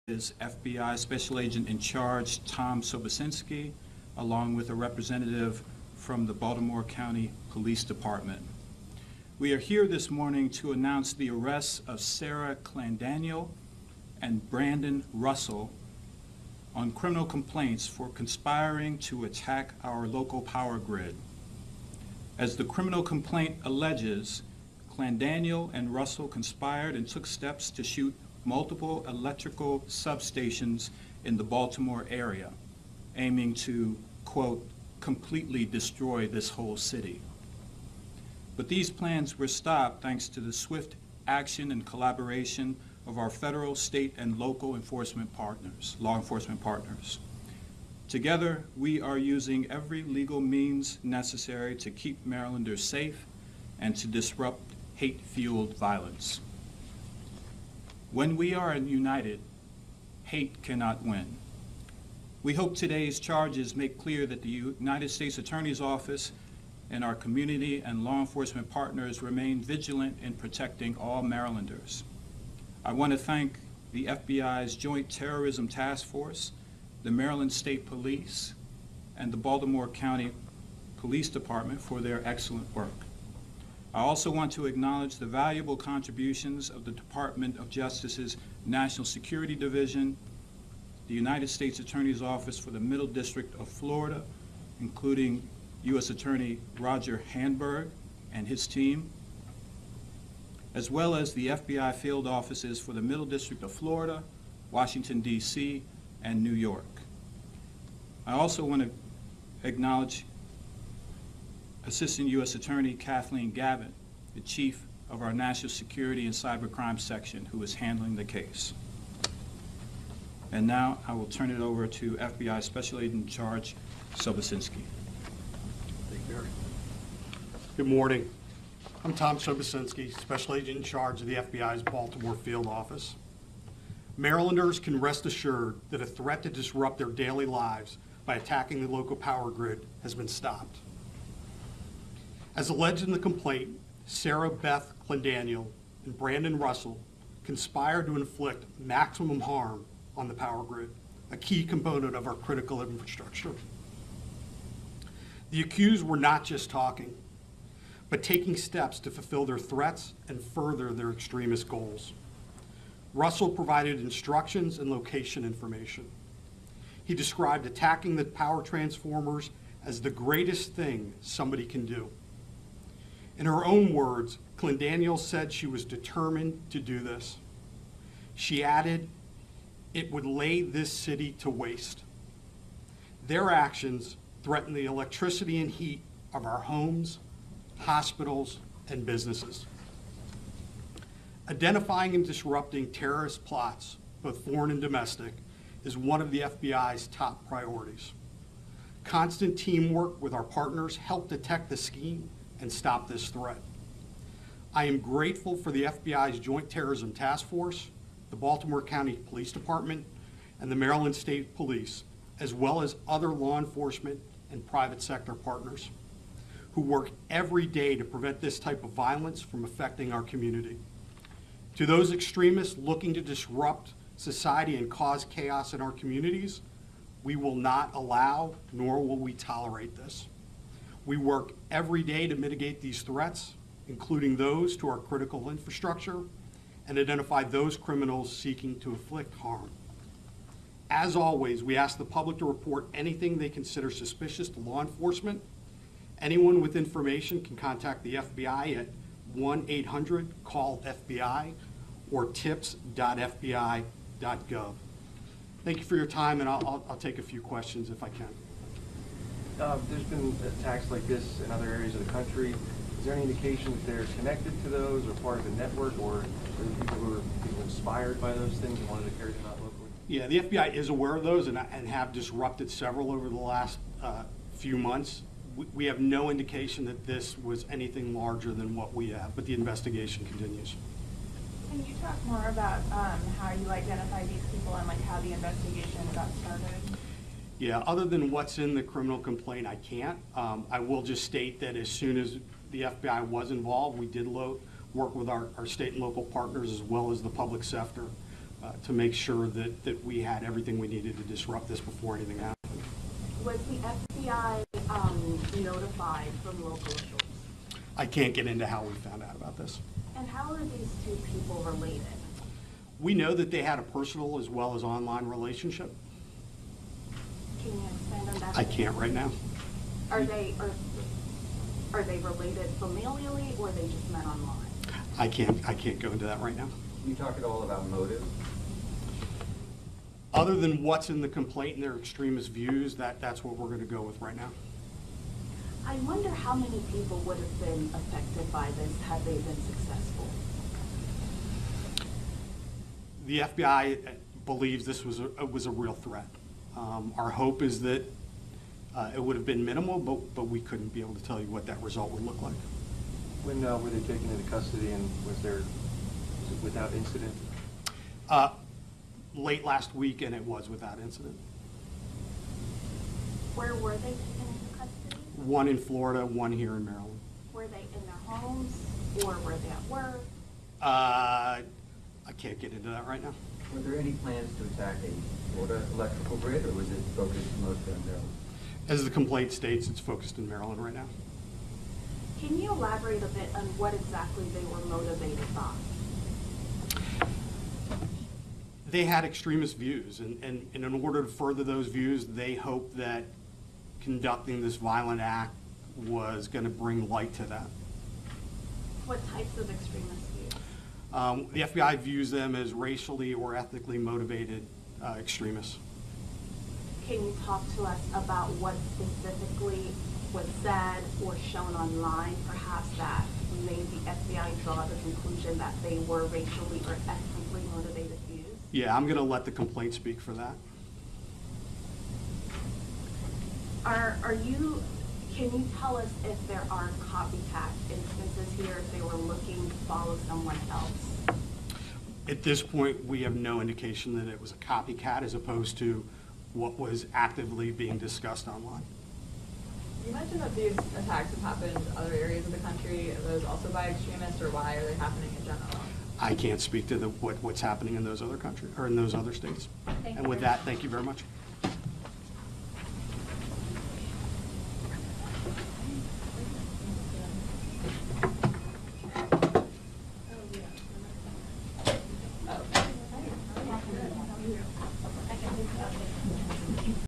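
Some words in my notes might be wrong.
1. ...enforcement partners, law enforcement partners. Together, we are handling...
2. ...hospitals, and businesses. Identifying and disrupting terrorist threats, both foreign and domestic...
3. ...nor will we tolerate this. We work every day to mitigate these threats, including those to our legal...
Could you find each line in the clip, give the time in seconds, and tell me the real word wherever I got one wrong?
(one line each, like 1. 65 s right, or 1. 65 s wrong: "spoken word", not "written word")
1. 44 s wrong: "using", not "handling"
2. 187 s wrong: "plots", not "threats"
3. 228 s wrong: "critical", not "legal".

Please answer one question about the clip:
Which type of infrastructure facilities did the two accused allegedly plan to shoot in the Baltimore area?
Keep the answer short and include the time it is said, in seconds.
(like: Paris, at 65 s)
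electrical substations, at 29 s.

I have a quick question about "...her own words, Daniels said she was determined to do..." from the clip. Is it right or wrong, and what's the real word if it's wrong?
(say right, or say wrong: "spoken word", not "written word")
right.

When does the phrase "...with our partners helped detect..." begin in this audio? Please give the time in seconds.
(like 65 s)
200 s.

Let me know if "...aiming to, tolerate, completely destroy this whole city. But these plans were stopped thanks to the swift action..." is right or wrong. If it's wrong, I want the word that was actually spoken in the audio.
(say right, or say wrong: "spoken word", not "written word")
wrong: "quote", not "tolerate".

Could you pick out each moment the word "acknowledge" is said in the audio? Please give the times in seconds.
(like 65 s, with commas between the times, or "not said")
84 s, 109 s.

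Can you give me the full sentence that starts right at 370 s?
Uh, I can't get into that right now.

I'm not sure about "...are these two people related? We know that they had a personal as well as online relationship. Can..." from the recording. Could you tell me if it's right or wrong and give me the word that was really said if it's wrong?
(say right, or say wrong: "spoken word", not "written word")
right.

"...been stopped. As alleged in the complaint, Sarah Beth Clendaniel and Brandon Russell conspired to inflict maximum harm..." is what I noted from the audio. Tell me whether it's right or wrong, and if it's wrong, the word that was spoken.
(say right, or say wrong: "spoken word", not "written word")
right.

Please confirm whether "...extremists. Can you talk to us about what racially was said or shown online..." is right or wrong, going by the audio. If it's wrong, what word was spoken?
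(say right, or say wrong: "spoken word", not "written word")
wrong: "specifically", not "racially".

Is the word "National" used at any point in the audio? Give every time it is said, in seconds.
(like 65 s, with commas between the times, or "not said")
88 s, 115 s.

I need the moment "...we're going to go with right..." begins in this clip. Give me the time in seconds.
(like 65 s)
333 s.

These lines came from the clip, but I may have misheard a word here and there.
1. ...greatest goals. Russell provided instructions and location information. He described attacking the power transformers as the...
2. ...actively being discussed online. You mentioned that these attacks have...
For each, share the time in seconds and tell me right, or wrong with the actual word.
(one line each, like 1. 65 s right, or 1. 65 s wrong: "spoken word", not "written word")
1. 161 s wrong: "extremist", not "greatest"
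2. 437 s right.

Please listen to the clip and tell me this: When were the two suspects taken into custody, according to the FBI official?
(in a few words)
late last week.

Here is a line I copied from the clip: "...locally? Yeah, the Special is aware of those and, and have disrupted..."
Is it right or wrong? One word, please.
wrong.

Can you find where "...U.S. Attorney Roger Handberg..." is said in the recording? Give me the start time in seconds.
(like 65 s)
95 s.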